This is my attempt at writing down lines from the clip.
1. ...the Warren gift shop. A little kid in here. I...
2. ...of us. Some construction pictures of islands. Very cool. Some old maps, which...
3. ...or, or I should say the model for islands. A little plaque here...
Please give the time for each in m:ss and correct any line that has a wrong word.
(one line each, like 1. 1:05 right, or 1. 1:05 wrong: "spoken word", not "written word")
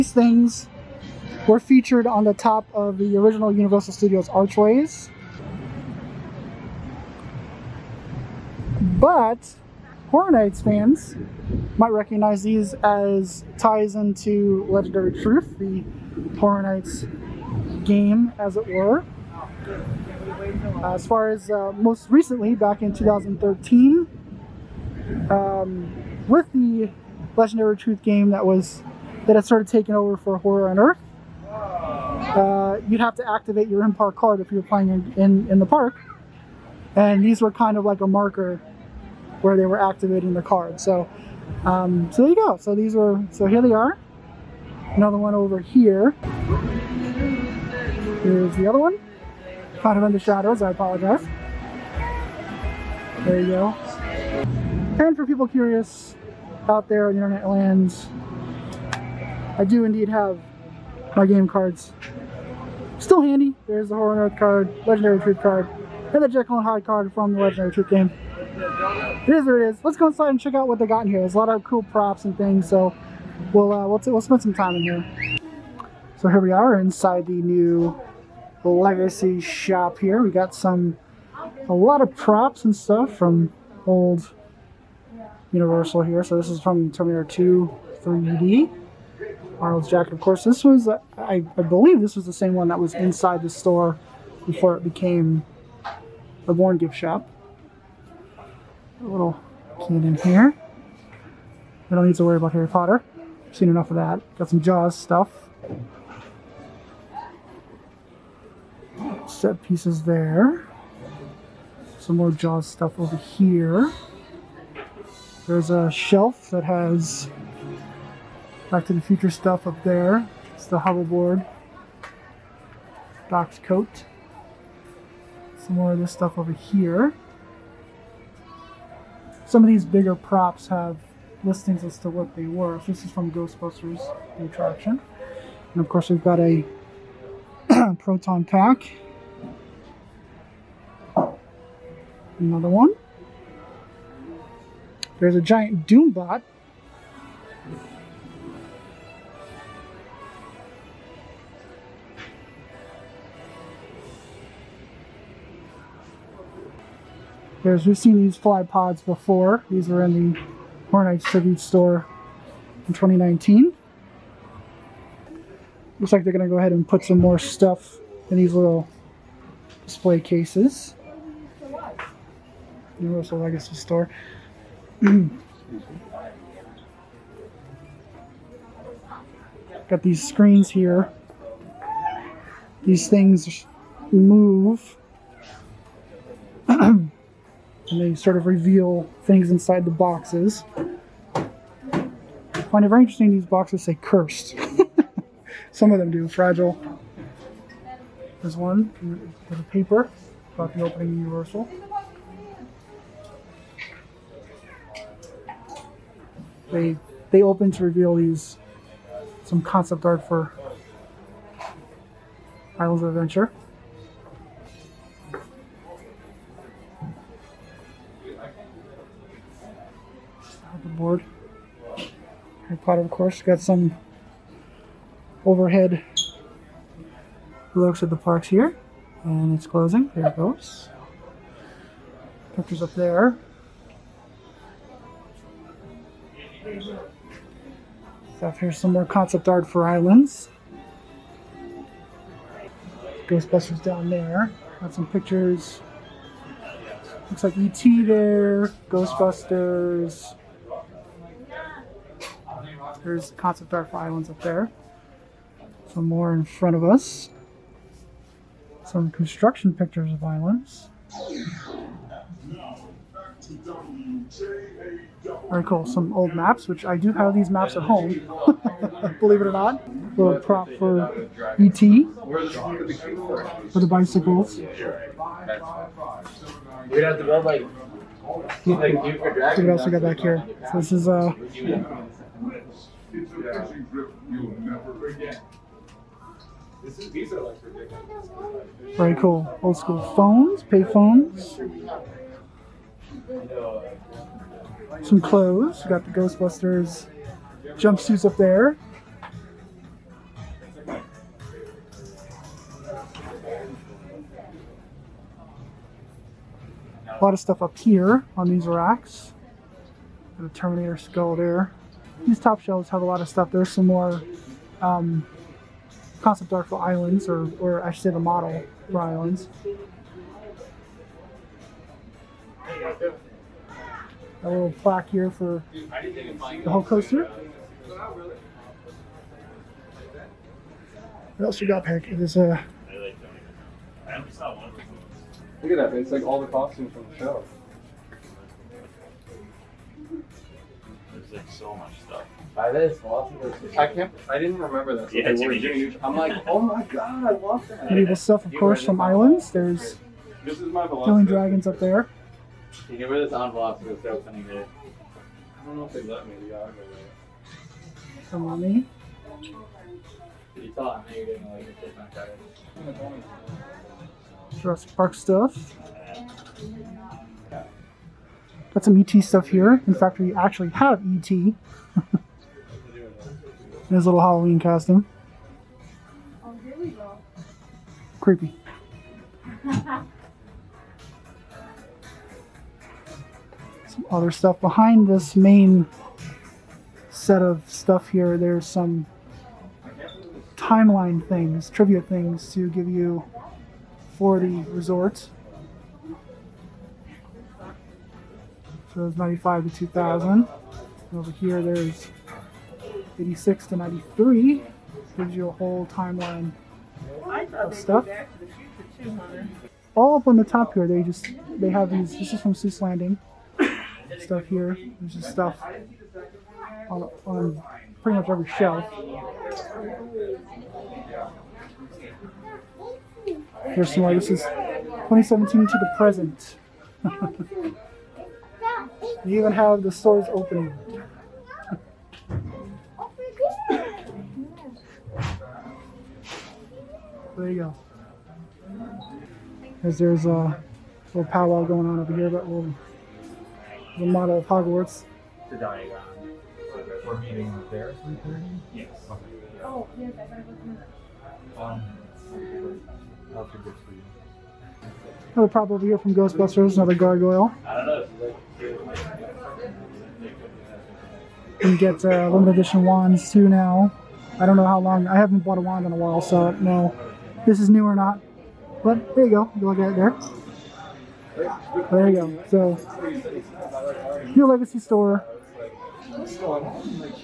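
1. 1:36 right
2. 4:16 right
3. 5:17 right.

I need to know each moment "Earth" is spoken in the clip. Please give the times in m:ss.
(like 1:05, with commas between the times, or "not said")
0:30, 1:04.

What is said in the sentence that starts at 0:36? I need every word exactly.
And these were kind of like a marker where they were activating the card.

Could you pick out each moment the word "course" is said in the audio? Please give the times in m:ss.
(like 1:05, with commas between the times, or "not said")
1:30, 2:15, 3:43, 5:48.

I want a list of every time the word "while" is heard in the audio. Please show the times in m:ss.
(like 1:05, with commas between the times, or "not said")
7:45.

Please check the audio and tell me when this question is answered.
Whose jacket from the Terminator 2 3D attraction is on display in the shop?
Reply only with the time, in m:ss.
1:29.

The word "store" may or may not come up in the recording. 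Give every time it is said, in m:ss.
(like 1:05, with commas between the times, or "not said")
1:33, 2:41, 2:53, 7:09, 7:54.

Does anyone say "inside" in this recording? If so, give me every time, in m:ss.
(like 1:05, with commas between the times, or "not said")
1:10, 1:16, 1:32, 3:09.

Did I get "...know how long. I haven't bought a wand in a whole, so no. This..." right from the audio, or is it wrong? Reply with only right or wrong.
wrong.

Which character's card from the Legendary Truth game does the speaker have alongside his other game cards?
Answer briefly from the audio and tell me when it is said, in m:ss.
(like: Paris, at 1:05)
Jekyll and Hyde, at 1:06.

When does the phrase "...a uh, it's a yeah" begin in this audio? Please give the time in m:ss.
4:41.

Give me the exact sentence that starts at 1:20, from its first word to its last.
We got some, a lot of props and stuff from old Universal here.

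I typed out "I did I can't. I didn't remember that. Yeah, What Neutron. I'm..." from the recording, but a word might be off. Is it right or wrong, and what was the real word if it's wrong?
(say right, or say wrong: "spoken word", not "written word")
wrong: "Jimmy", not "What".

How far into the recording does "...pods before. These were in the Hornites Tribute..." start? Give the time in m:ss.
2:38.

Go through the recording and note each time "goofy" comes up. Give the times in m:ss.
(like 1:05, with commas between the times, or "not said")
not said.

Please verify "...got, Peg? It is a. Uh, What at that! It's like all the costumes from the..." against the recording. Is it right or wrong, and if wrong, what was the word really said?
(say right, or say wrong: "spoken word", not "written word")
wrong: "Look", not "What".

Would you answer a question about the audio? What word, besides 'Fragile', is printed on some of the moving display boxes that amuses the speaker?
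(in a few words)
Cursed.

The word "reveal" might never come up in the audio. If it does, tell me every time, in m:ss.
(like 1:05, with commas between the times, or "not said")
3:08, 3:27.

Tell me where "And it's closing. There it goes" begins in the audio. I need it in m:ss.
3:49.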